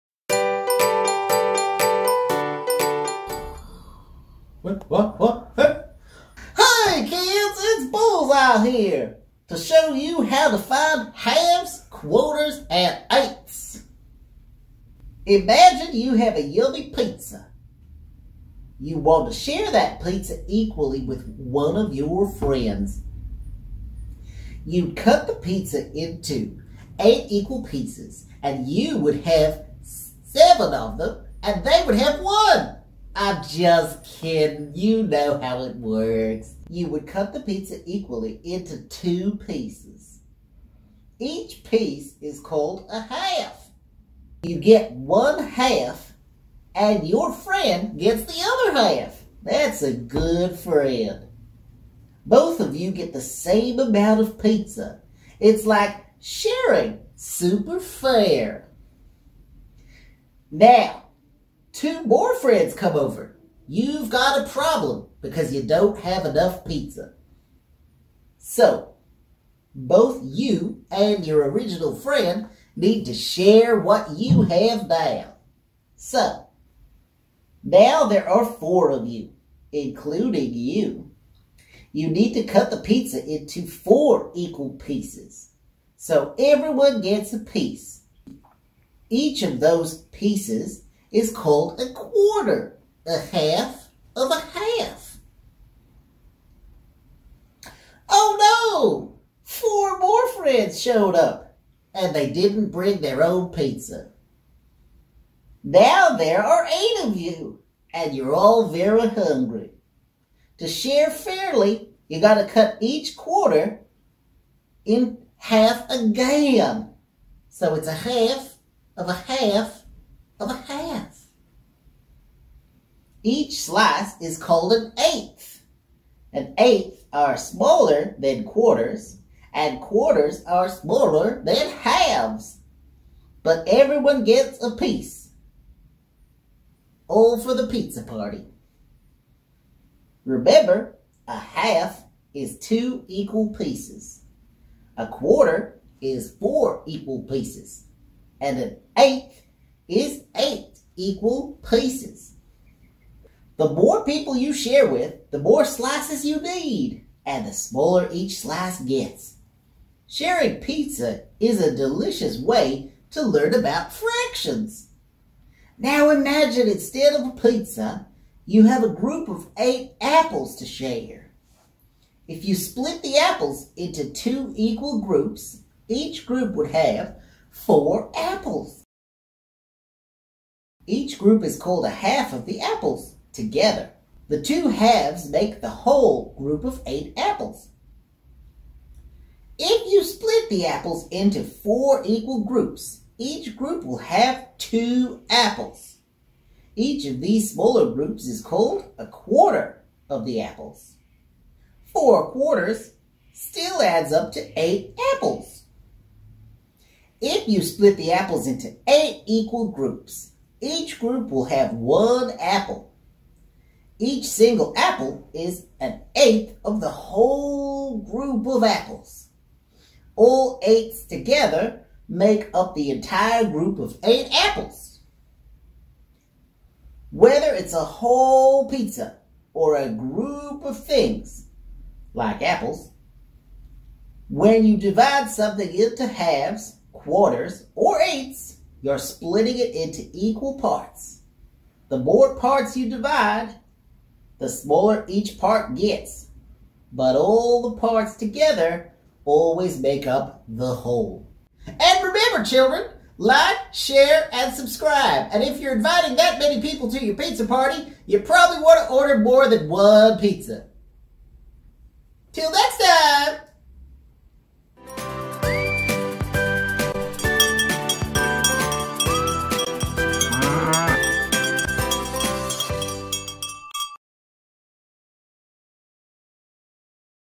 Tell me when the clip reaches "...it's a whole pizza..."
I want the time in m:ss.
3:47.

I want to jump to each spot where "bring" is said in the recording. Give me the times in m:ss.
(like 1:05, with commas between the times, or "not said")
1:42.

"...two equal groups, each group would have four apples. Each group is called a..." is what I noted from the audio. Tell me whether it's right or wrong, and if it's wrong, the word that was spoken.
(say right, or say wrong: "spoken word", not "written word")
right.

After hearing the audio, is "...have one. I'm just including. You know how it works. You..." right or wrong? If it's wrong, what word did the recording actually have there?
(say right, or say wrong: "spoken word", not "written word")
wrong: "kidding", not "including".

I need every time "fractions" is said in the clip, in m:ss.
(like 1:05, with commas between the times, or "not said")
2:43.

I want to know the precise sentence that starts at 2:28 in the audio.
And an eighth is eight equal pieces.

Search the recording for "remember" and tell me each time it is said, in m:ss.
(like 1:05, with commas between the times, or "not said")
2:20, 4:12.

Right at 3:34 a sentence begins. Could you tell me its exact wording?
Each single apple is an eighth of the whole group of apples.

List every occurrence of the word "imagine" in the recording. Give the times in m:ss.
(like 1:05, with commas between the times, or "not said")
0:15, 2:46.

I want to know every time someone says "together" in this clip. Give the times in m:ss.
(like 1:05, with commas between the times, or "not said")
3:03, 3:41, 4:08.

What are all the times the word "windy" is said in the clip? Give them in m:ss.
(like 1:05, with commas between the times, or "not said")
not said.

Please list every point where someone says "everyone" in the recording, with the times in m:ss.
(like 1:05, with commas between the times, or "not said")
1:26, 2:13.